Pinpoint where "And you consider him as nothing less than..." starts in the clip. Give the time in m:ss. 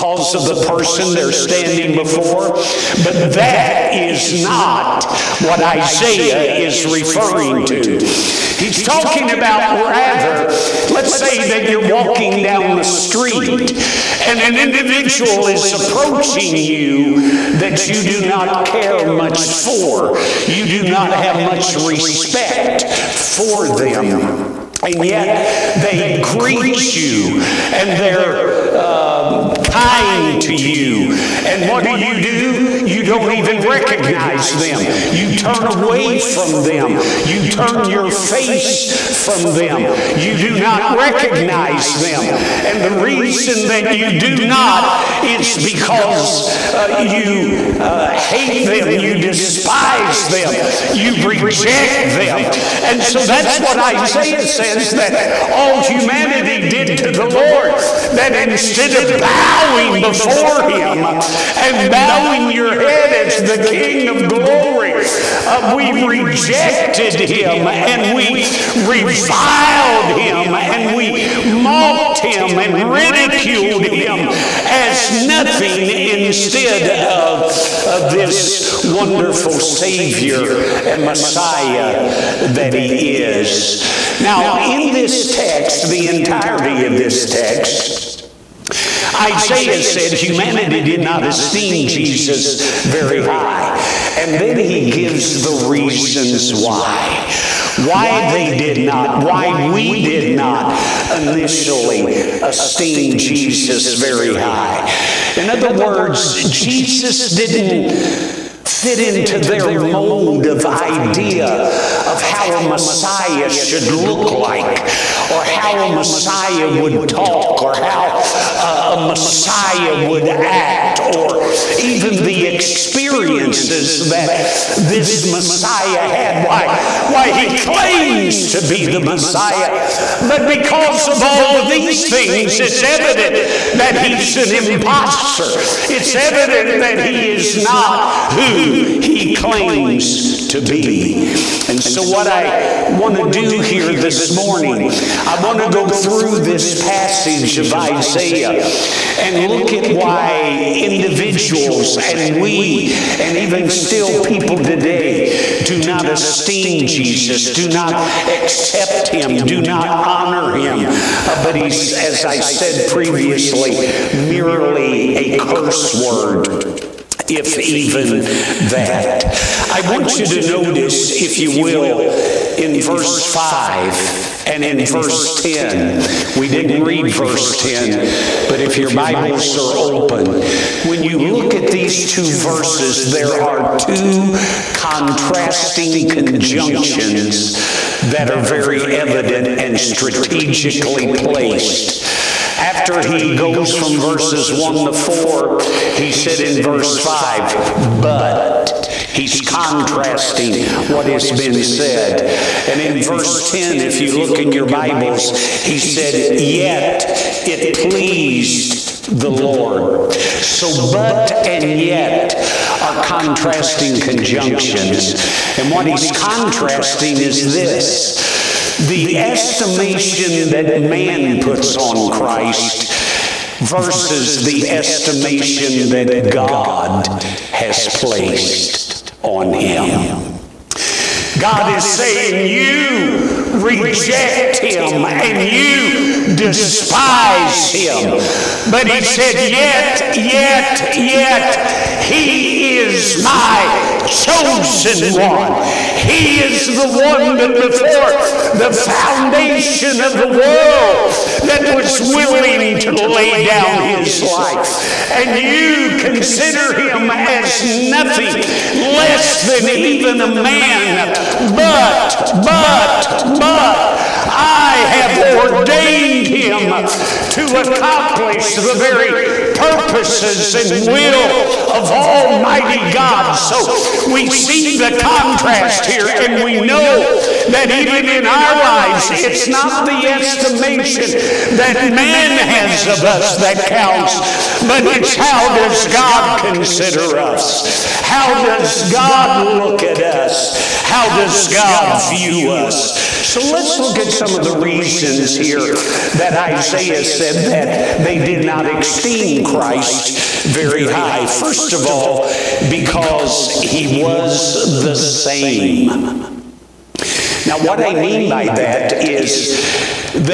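4:15.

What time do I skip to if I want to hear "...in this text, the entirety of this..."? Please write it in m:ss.
1:24.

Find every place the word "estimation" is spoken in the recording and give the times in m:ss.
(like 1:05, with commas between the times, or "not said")
3:39, 3:44, 4:40.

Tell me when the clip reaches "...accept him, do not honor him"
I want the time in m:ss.
2:38.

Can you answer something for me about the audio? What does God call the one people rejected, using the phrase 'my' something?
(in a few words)
chosen one.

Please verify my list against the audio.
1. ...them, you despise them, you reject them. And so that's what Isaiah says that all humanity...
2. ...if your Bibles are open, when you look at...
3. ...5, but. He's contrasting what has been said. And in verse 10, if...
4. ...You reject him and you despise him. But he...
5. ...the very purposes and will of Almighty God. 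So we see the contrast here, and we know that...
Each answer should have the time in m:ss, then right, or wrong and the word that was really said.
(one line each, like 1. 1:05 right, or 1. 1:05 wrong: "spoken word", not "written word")
1. 0:48 right
2. 2:58 right
3. 3:16 right
4. 3:52 right
5. 4:28 right.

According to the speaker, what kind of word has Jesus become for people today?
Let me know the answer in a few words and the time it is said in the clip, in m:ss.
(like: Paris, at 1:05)
curse word, at 2:45.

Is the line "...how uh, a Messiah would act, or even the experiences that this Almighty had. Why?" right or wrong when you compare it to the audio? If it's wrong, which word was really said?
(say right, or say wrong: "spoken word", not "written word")
wrong: "Messiah", not "Almighty".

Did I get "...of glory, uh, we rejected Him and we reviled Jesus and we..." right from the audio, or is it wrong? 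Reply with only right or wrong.
wrong.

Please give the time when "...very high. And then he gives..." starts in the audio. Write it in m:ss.
1:32.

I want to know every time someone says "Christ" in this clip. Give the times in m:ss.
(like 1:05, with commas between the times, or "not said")
3:42, 4:59.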